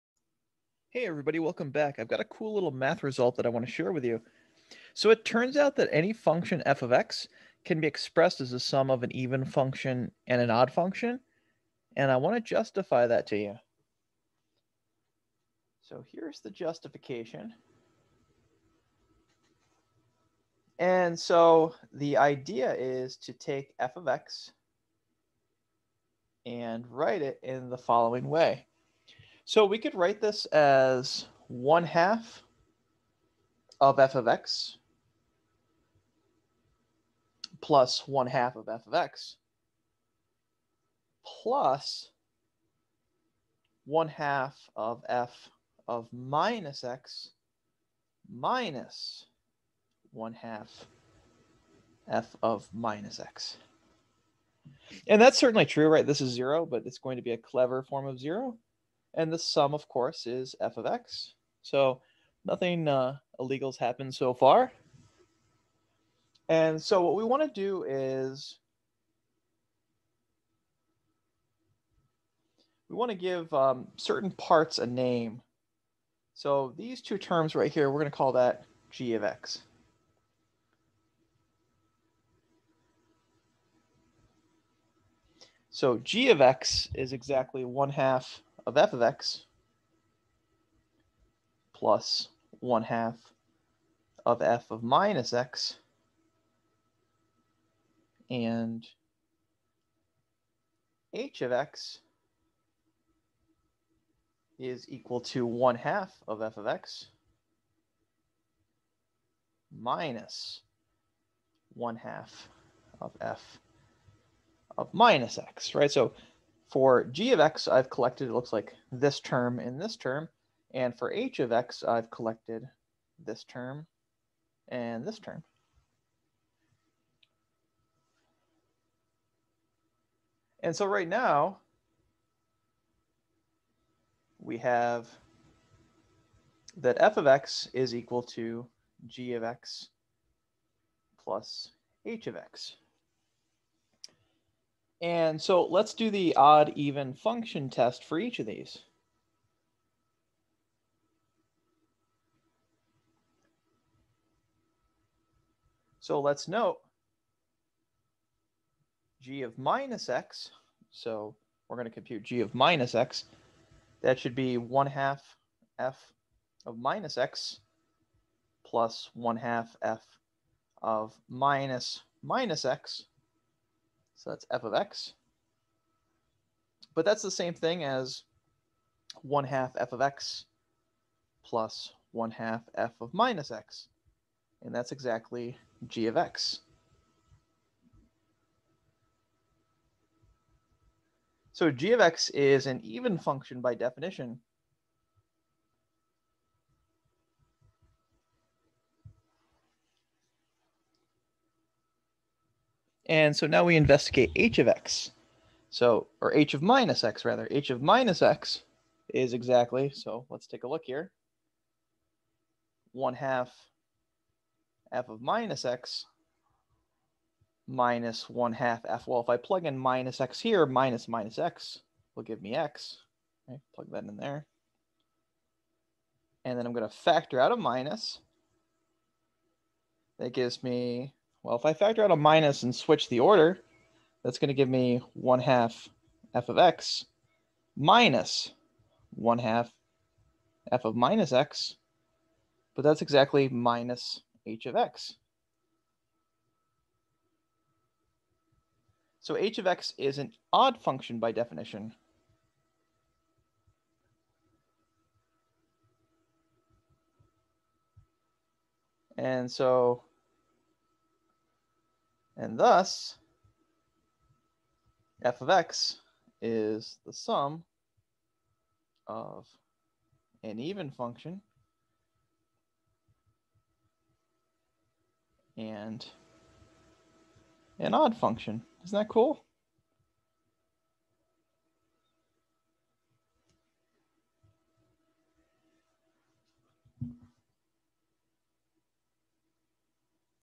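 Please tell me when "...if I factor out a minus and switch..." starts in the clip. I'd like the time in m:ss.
3:51.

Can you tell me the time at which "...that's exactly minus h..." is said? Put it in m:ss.
4:02.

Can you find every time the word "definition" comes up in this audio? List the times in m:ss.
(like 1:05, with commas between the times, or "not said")
3:13, 4:11.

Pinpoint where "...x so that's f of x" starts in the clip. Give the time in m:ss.
2:52.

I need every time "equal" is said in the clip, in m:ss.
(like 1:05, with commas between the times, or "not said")
1:44, 2:17.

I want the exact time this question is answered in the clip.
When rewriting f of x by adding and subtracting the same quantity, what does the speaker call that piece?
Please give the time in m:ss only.
0:57.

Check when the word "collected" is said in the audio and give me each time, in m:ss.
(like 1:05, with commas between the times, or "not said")
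1:57, 2:02.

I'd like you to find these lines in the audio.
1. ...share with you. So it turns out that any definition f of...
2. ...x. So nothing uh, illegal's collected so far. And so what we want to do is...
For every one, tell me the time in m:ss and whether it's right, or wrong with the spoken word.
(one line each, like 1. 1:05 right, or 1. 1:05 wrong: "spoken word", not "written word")
1. 0:03 wrong: "function", not "definition"
2. 1:00 wrong: "happened", not "collected".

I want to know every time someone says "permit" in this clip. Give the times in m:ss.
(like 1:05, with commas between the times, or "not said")
not said.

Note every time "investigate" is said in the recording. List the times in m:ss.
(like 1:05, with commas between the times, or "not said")
3:23.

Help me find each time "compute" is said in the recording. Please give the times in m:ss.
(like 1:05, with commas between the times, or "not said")
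2:41.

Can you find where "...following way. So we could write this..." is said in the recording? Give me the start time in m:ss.
0:27.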